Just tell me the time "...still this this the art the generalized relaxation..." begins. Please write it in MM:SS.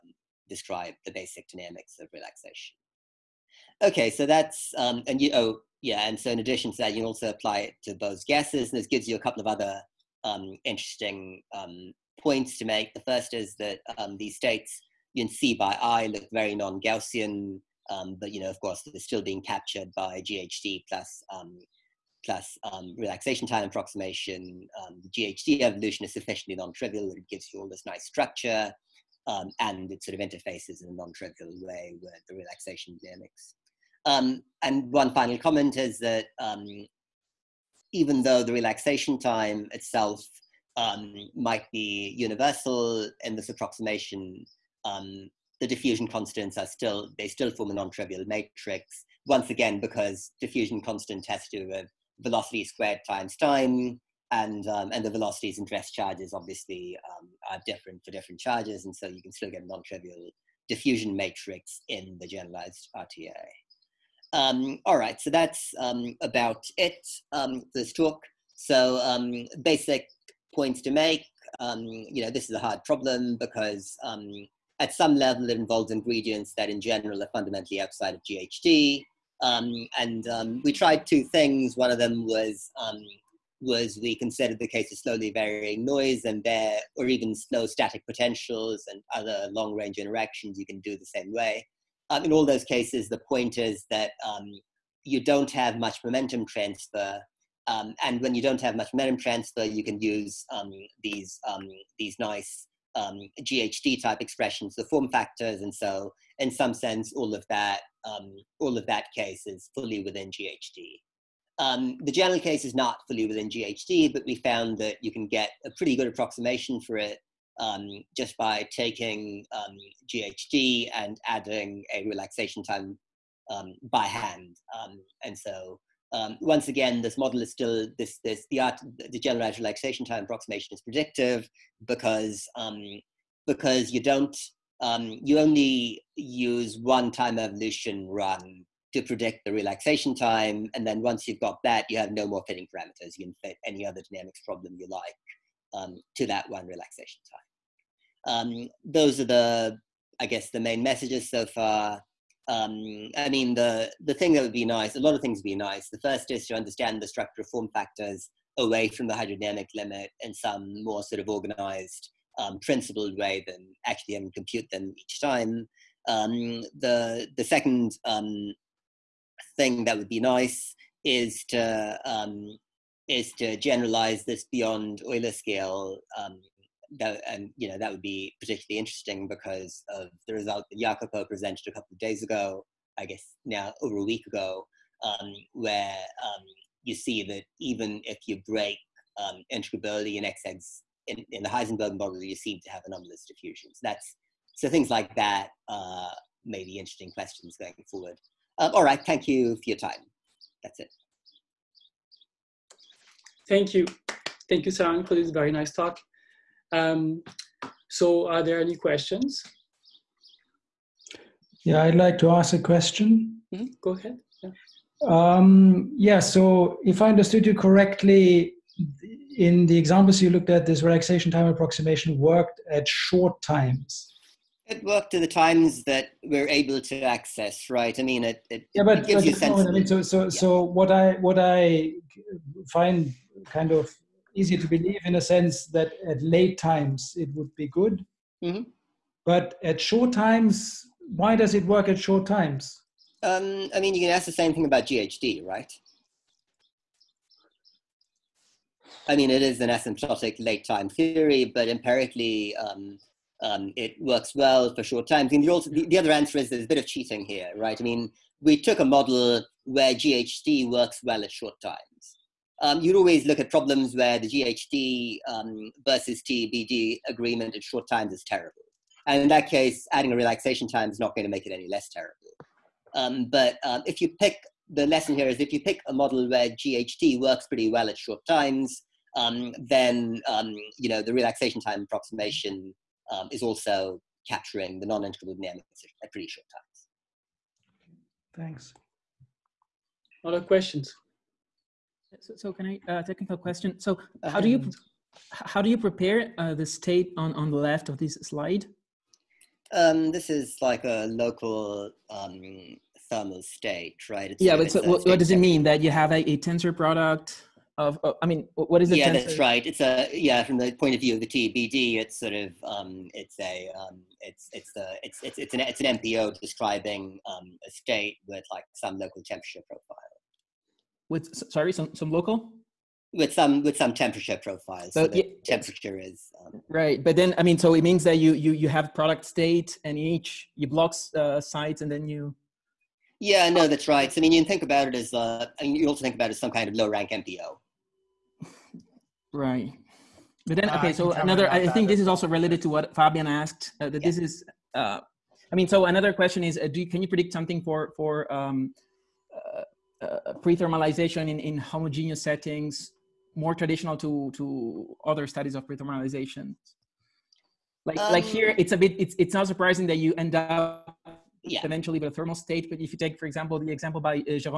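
02:07.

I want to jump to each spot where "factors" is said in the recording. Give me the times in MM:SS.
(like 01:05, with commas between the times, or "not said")
01:45, 02:37.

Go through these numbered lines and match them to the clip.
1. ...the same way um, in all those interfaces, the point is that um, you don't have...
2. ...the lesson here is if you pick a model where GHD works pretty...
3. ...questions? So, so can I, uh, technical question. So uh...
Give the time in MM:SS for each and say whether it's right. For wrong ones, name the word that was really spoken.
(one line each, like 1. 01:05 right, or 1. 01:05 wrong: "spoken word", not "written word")
1. 01:30 wrong: "cases", not "interfaces"
2. 04:34 right
3. 04:50 right.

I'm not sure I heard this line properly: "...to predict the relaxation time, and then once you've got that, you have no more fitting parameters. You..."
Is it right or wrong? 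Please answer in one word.
right.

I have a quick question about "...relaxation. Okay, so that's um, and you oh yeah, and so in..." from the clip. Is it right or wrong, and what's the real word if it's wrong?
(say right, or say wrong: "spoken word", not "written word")
right.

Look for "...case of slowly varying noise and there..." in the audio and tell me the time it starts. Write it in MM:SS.
01:24.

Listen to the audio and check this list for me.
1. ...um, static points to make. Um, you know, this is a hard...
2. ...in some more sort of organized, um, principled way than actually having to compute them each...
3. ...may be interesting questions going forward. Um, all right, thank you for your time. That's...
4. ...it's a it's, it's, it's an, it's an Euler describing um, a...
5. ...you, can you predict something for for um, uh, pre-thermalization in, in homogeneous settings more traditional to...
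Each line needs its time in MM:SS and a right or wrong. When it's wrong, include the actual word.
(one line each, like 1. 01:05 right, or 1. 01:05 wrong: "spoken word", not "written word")
1. 01:09 wrong: "basic", not "static"
2. 02:40 right
3. 03:16 right
4. 05:14 wrong: "MPO", not "Euler"
5. 05:46 right.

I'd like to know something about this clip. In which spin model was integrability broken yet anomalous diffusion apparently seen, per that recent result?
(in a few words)
Heisenberg model.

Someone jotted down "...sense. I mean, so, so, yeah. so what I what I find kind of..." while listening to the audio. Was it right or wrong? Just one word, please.
right.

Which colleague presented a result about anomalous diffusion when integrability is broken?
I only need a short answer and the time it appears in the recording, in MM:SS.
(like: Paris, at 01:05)
Jacopo, at 03:00.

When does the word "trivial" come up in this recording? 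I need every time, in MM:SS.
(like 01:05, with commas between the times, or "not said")
00:26, 00:30, 00:47, 00:59.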